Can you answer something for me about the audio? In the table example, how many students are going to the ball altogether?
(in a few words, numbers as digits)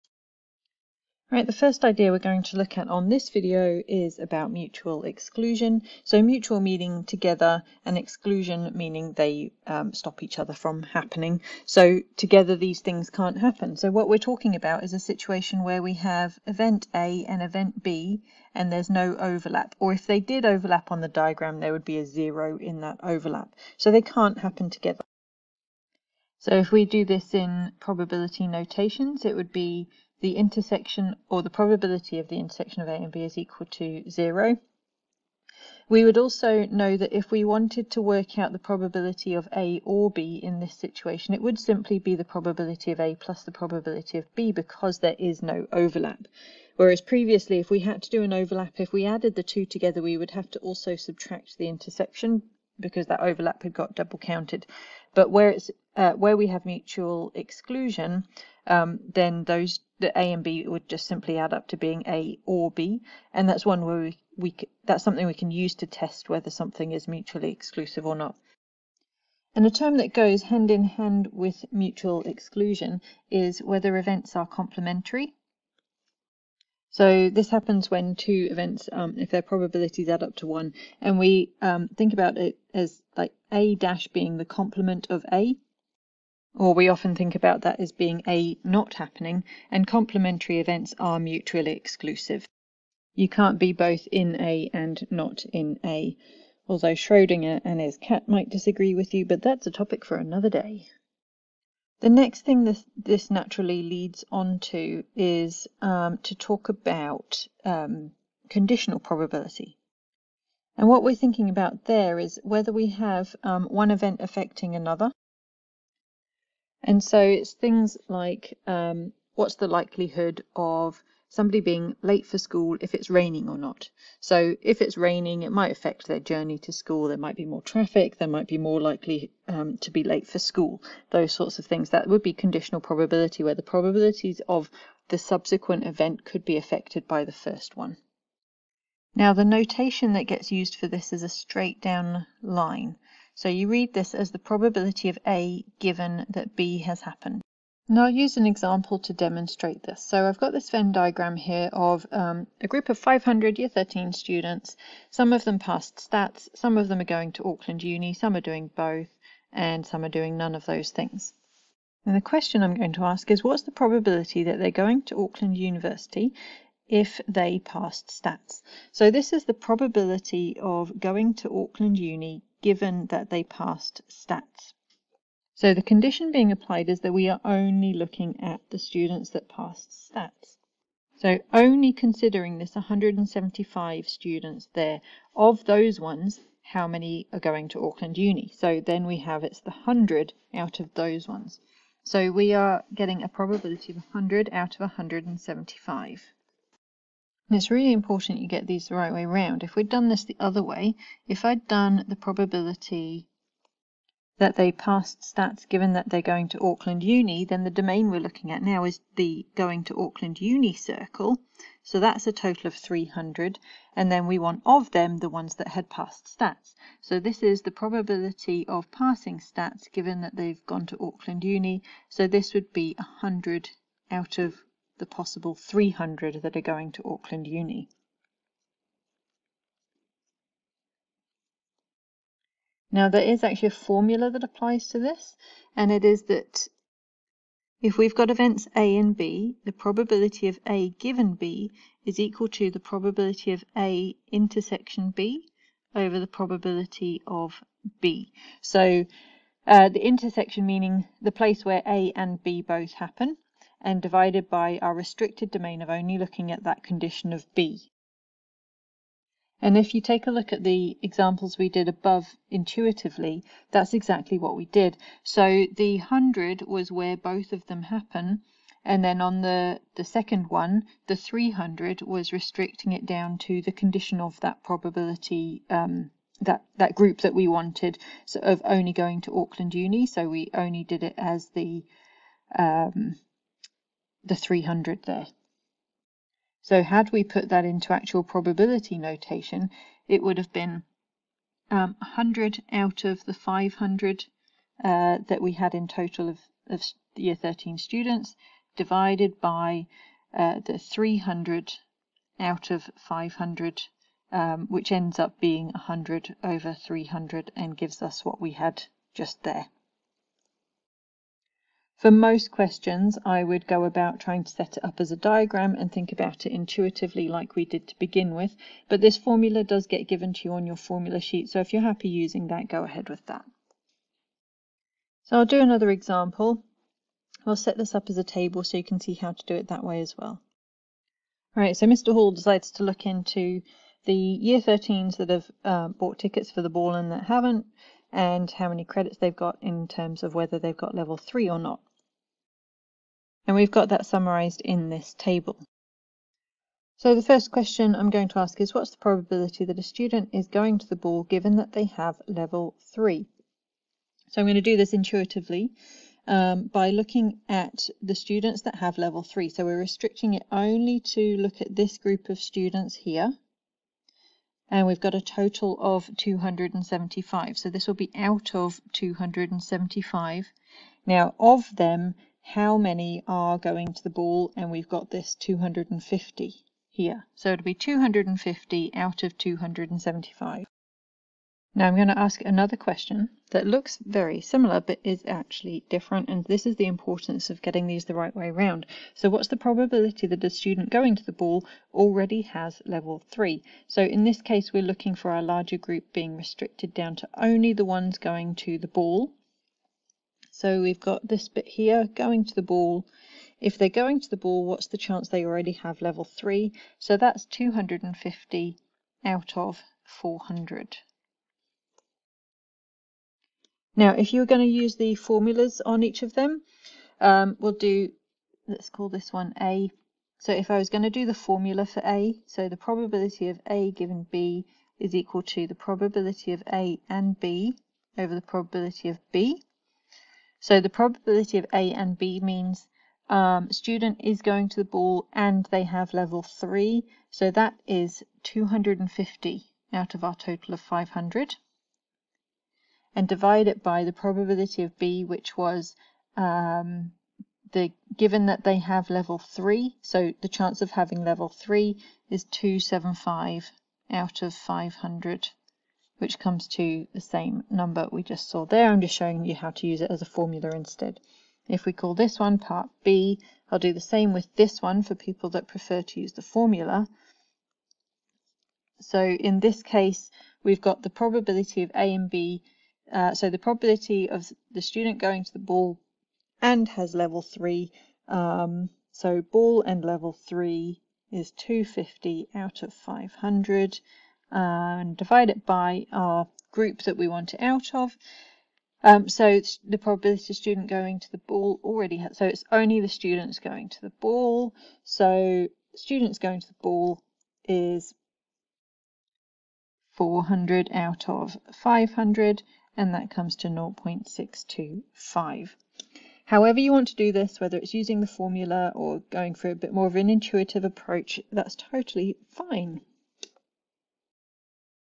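400.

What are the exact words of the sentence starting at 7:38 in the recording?
I'm just showing you how to use it as a formula instead.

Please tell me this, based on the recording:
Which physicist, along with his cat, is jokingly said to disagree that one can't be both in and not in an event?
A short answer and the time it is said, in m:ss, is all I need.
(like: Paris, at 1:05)
Schrodinger, at 1:36.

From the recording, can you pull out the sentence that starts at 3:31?
So that's a total of 300.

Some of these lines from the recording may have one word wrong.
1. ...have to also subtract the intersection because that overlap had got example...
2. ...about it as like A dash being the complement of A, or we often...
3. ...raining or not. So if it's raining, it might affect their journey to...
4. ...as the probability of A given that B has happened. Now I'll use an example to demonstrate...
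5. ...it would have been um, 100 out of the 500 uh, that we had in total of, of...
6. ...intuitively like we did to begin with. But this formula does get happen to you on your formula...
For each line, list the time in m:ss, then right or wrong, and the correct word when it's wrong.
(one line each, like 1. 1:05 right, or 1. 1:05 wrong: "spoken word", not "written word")
1. 0:50 wrong: "double", not "example"
2. 1:22 right
3. 2:03 right
4. 2:24 right
5. 4:50 right
6. 5:16 wrong: "given", not "happen".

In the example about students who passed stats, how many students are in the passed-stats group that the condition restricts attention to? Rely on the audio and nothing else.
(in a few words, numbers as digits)
175.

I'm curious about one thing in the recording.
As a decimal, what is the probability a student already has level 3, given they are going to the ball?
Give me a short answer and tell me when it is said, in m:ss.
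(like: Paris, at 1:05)
0.625, at 8:23.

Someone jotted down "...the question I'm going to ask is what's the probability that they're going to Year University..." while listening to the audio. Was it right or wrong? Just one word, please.
wrong.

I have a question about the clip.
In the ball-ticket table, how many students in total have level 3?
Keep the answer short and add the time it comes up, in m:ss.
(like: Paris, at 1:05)
275, at 6:05.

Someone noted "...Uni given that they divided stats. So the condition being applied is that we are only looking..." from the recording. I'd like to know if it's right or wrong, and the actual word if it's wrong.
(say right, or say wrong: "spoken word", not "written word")
wrong: "passed", not "divided".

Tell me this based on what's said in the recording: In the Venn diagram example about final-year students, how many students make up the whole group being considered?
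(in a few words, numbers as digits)
500.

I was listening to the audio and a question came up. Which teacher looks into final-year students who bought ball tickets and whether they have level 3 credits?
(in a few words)
Mr. Hall.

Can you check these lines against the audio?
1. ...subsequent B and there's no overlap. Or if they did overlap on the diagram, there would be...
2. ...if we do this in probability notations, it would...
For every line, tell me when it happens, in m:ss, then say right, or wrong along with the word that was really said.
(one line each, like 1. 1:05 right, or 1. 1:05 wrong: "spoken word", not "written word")
1. 0:17 wrong: "event", not "subsequent"
2. 0:26 right.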